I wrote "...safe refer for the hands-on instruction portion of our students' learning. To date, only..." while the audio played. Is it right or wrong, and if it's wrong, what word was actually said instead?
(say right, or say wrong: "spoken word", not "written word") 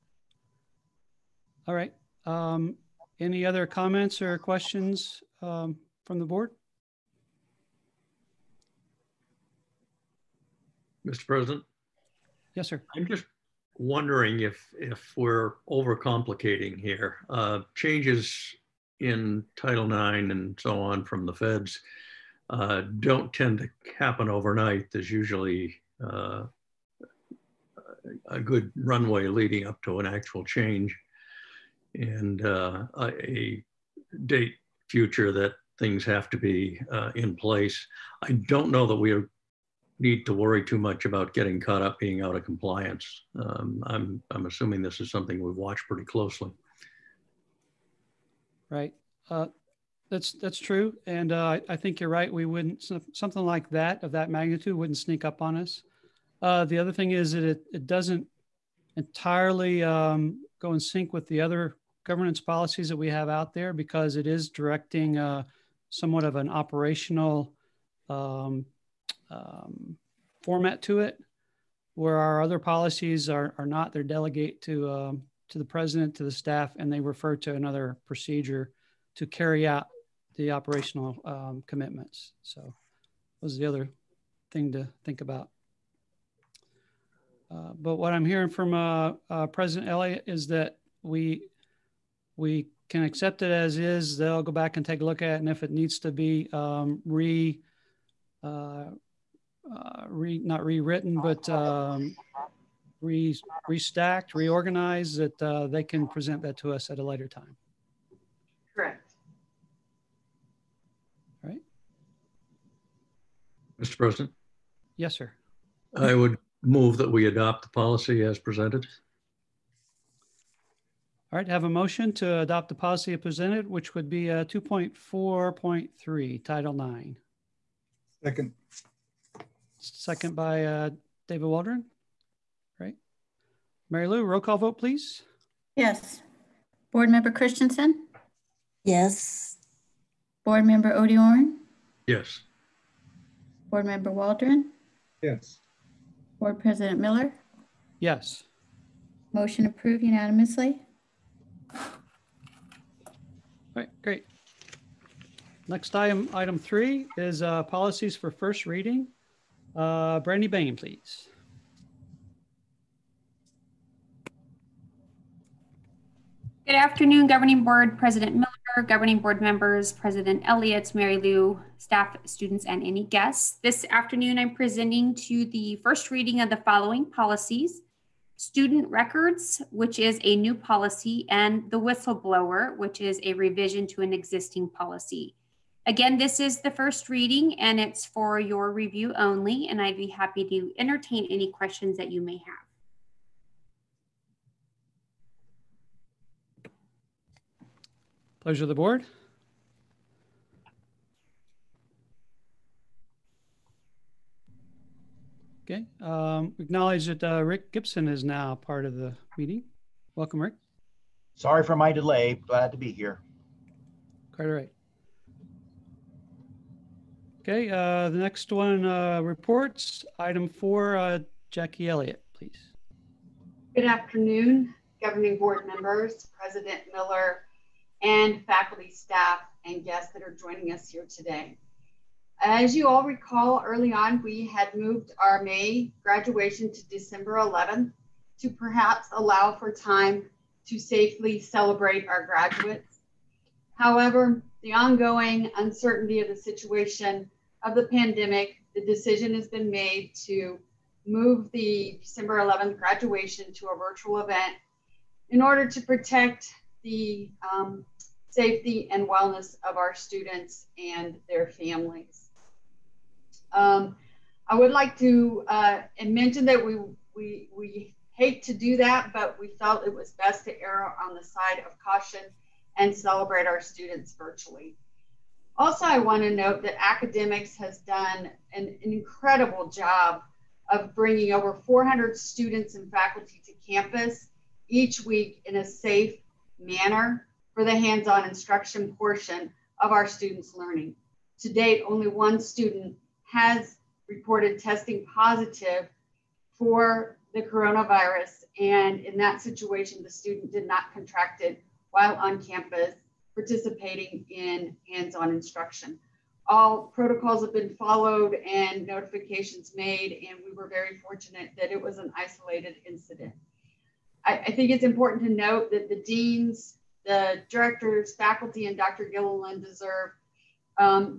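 wrong: "manner", not "refer".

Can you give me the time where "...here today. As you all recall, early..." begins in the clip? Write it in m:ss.
3:50.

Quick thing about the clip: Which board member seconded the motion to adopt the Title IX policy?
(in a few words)
David Waldron.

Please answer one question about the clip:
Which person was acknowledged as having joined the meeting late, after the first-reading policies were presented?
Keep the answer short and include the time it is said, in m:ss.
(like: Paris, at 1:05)
Rick Gibson, at 3:27.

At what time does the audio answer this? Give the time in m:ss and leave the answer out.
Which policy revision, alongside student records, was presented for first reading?
3:01.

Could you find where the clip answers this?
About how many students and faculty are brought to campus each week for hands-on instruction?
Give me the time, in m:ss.
4:41.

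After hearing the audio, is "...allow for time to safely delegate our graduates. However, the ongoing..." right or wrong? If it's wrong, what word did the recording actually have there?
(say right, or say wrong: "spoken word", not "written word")
wrong: "celebrate", not "delegate".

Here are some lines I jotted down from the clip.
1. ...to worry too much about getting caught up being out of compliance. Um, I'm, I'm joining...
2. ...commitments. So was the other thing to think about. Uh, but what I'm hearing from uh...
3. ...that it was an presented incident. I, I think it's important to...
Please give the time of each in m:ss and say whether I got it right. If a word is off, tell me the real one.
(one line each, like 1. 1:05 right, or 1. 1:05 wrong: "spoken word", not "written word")
1. 0:40 wrong: "assuming", not "joining"
2. 1:21 right
3. 5:11 wrong: "isolated", not "presented".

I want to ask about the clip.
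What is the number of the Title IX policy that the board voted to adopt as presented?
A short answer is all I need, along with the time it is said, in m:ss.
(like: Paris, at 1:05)
2.4.3, at 2:04.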